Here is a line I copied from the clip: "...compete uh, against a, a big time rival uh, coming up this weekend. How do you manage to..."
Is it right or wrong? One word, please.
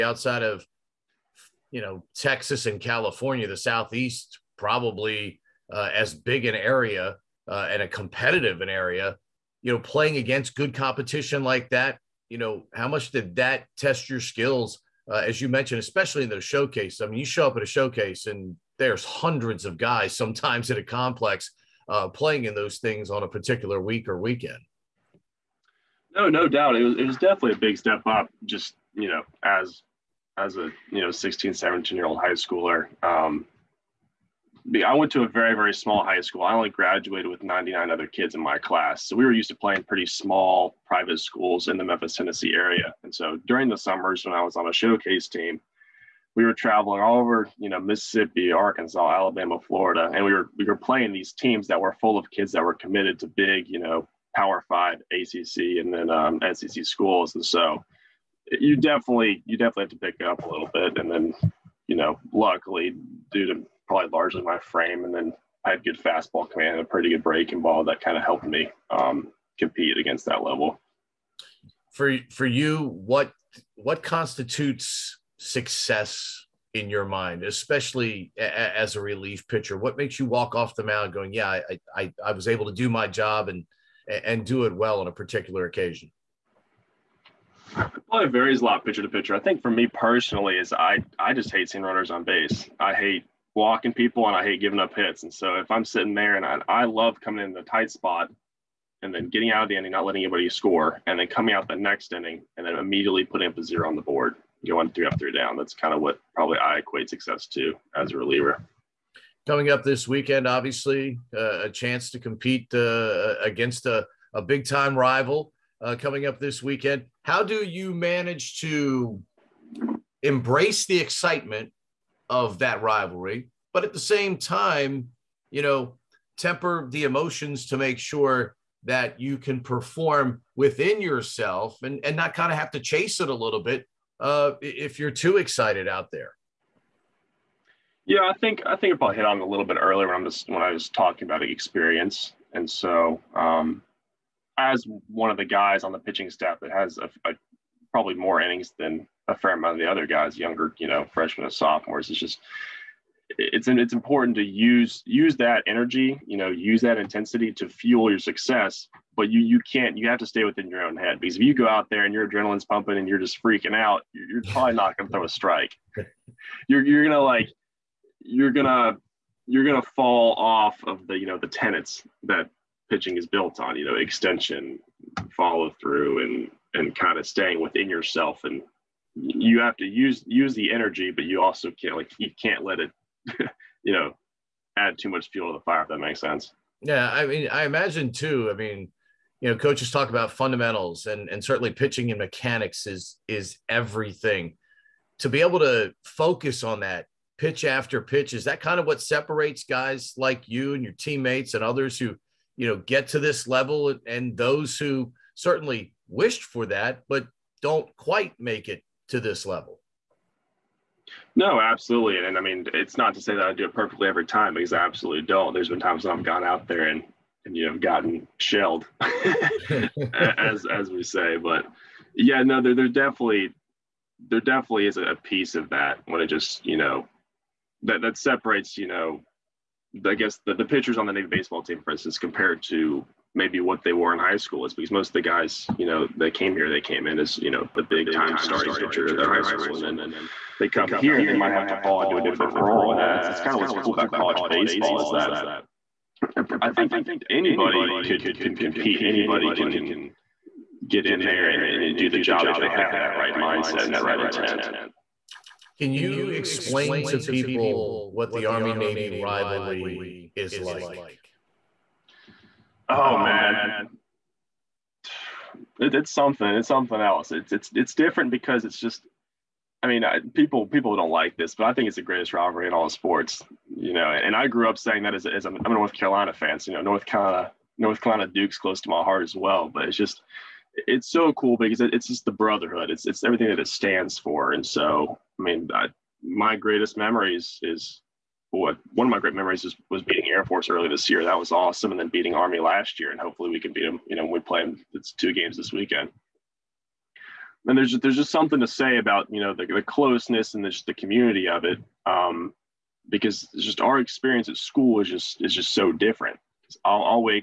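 right.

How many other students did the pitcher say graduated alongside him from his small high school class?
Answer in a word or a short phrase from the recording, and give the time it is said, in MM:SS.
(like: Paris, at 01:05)
99, at 00:37.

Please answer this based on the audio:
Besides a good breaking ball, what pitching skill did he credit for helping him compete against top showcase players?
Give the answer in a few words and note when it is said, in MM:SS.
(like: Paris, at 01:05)
Fastball command, at 01:06.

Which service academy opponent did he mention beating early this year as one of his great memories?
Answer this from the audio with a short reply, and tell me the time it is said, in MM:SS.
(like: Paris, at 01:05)
Air Force, at 04:50.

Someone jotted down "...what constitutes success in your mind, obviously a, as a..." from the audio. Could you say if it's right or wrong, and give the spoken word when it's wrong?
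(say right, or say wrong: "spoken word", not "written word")
wrong: "especially", not "obviously".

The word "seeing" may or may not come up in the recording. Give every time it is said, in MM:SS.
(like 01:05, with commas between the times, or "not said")
01:31.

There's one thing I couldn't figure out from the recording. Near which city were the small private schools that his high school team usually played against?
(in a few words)
Memphis, Tennessee.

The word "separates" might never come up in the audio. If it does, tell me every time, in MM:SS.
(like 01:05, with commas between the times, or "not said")
03:19, 03:48.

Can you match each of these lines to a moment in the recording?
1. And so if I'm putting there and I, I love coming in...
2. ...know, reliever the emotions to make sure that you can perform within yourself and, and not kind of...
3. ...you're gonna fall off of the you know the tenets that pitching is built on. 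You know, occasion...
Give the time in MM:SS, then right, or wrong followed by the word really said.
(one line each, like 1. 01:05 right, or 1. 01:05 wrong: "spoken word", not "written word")
1. 01:35 wrong: "sitting", not "putting"
2. 02:05 wrong: "temper", not "reliever"
3. 02:49 wrong: "extension", not "occasion".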